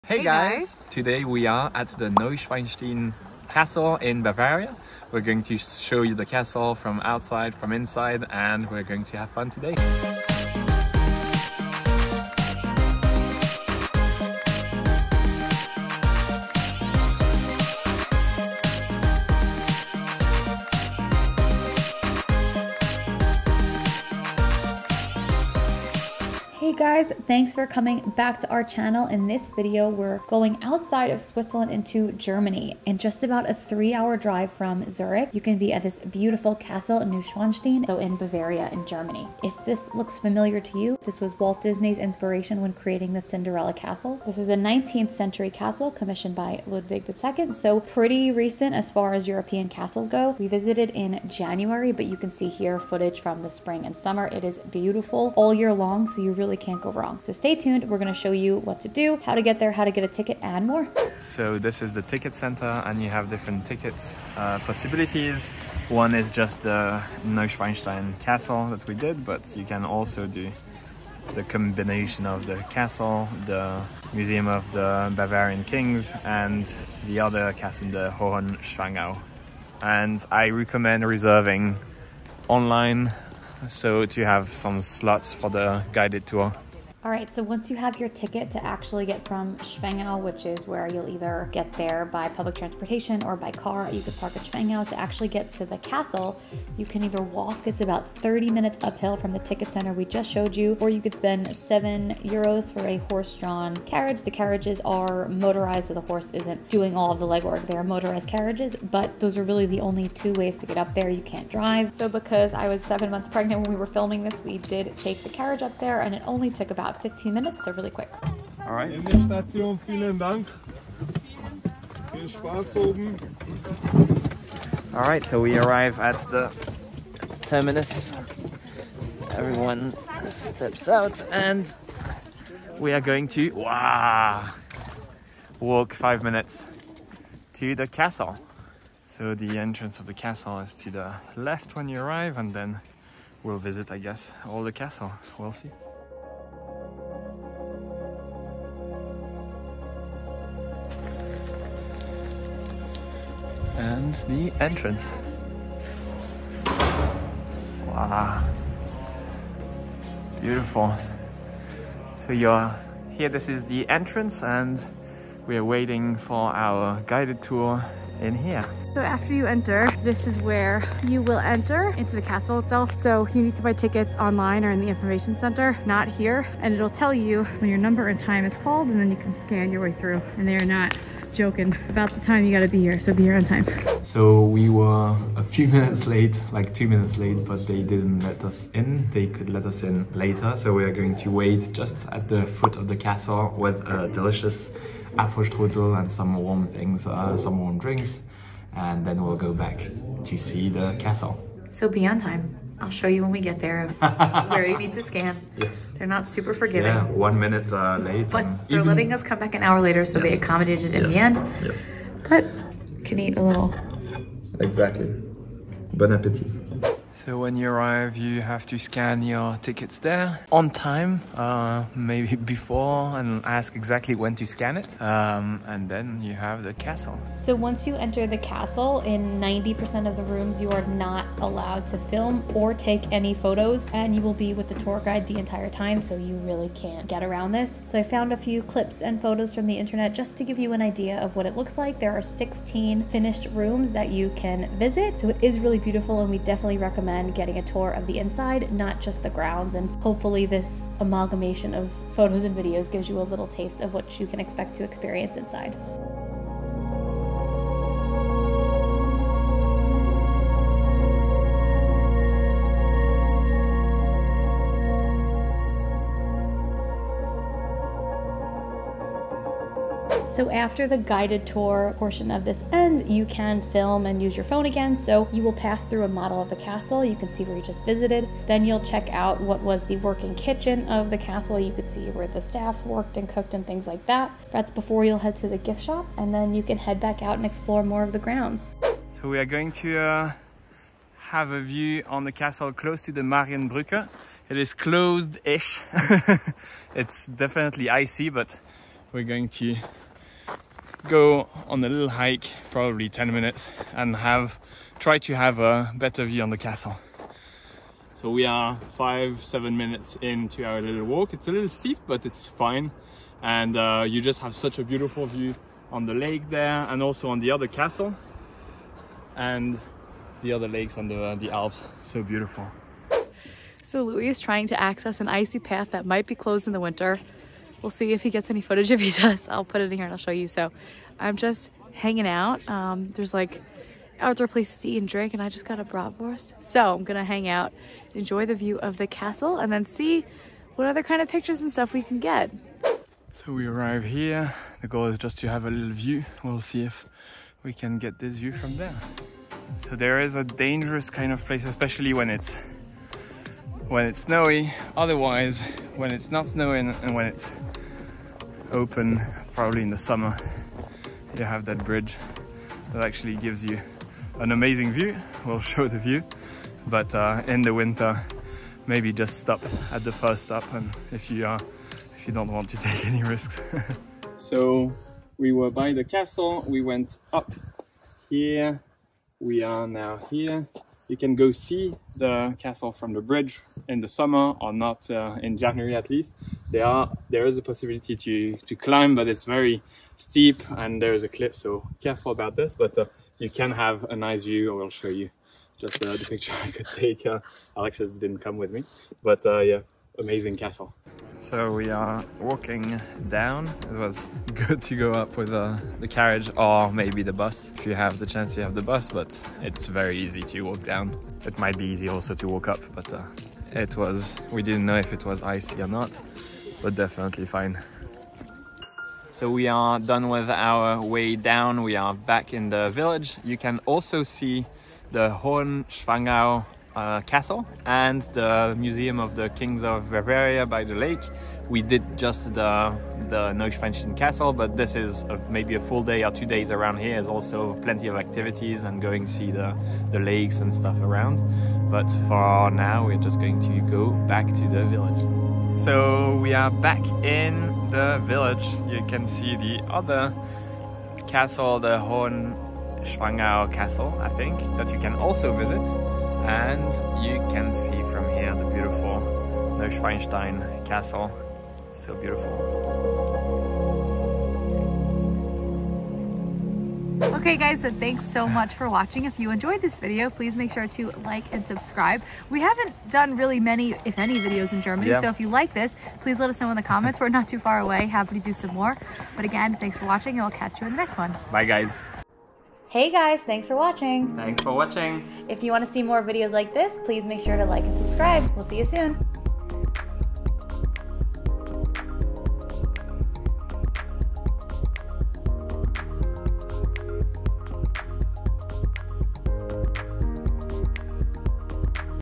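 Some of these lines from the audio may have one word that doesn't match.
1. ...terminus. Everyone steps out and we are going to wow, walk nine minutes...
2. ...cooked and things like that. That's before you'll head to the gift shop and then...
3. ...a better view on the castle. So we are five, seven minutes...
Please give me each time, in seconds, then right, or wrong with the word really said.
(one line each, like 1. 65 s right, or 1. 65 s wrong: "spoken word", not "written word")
1. 127 s wrong: "five", not "nine"
2. 283 s right
3. 305 s right.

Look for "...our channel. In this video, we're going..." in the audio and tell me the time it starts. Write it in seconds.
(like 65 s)
28 s.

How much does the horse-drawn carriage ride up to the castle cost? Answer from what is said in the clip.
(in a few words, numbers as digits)
7 euros.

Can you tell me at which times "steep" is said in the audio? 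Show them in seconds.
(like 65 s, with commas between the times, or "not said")
311 s, 390 s.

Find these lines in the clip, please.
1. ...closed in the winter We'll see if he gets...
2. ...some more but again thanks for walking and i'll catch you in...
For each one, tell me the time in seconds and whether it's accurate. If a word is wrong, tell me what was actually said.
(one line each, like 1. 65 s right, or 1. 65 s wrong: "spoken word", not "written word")
1. 326 s right
2. 478 s wrong: "watching", not "walking".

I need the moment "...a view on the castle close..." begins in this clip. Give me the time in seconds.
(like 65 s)
291 s.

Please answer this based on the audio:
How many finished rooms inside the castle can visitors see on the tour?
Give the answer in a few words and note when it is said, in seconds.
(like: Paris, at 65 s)
16, at 242 s.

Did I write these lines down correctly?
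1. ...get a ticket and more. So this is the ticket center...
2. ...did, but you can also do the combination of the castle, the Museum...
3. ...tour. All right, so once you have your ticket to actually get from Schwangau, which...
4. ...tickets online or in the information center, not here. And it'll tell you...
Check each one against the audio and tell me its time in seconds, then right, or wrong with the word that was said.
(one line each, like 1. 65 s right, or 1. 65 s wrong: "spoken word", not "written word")
1. 59 s right
2. 68 s right
3. 86 s right
4. 173 s right.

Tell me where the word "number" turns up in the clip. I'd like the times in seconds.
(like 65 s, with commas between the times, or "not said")
177 s.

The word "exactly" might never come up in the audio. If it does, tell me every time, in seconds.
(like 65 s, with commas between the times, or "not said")
214 s, 223 s.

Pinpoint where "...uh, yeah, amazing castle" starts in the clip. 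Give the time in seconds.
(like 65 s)
399 s.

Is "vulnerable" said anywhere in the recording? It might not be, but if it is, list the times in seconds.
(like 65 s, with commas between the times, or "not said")
not said.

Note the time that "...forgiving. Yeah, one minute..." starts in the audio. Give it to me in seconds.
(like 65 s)
206 s.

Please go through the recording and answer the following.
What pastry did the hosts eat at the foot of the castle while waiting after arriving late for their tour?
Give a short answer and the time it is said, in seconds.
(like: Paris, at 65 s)
Apfelstrudel, at 195 s.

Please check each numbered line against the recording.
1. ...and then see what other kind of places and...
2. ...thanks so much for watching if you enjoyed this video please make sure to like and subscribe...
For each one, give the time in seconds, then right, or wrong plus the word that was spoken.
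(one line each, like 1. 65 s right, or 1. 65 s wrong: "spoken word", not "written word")
1. 339 s wrong: "pictures", not "places"
2. 467 s right.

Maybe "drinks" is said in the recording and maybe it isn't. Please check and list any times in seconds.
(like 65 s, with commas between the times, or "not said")
197 s, 335 s.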